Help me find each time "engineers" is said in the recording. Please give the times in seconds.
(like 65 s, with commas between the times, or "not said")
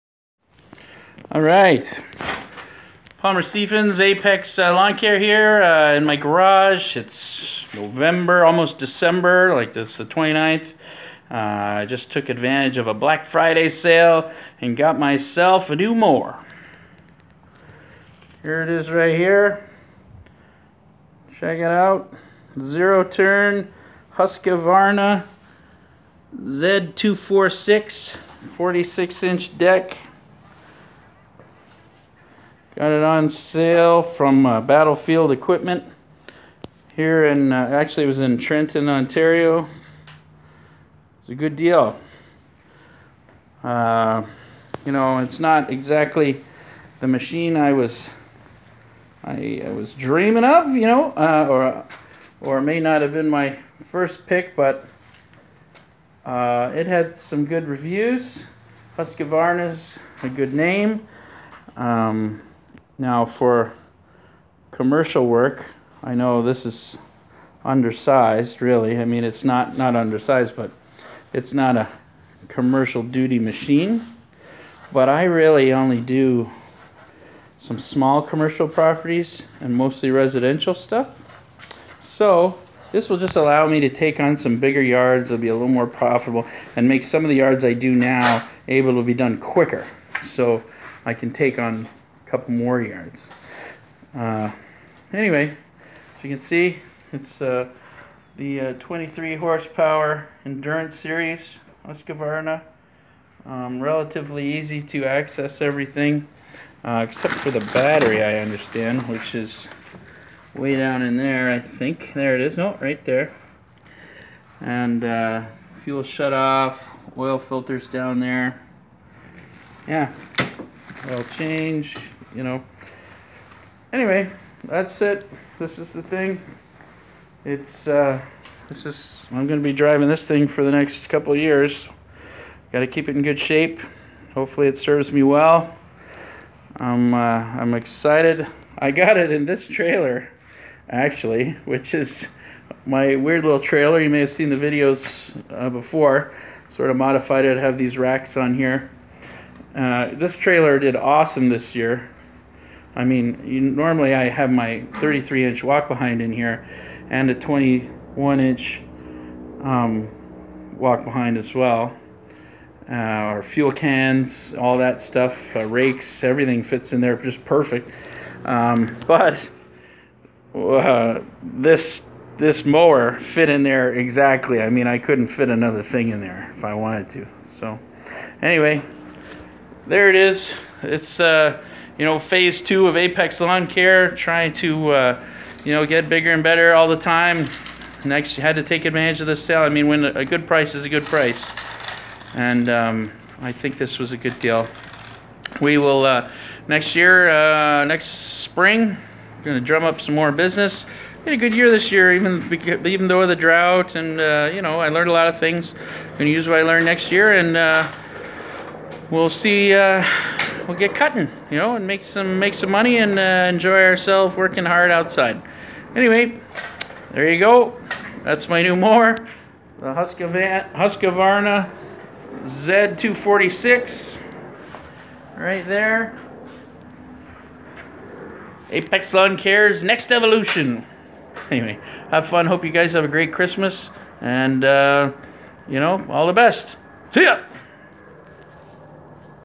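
not said.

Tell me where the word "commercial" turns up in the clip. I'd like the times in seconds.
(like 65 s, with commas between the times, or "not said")
64 s, 72 s, 78 s.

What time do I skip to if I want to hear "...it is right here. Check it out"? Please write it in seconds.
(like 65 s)
18 s.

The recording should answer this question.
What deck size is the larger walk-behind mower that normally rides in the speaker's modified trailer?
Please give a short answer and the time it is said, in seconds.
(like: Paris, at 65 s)
33 inch, at 154 s.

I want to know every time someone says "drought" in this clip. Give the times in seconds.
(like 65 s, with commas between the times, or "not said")
203 s.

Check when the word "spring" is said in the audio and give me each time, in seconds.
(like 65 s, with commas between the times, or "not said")
198 s.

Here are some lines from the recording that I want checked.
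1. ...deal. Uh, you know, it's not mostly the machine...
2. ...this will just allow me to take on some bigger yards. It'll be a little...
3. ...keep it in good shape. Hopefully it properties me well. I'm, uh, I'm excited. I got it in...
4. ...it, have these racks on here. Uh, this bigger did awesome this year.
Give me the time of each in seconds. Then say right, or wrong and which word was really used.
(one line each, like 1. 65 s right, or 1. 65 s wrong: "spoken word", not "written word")
1. 41 s wrong: "exactly", not "mostly"
2. 82 s right
3. 132 s wrong: "serves", not "properties"
4. 147 s wrong: "trailer", not "bigger".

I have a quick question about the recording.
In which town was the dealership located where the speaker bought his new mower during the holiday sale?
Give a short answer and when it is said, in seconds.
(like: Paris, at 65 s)
Trenton, Ontario, at 38 s.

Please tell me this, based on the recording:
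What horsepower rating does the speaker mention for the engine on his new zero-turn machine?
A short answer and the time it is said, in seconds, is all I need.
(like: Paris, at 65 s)
23, at 98 s.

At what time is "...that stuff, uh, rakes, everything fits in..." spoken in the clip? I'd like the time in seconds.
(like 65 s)
164 s.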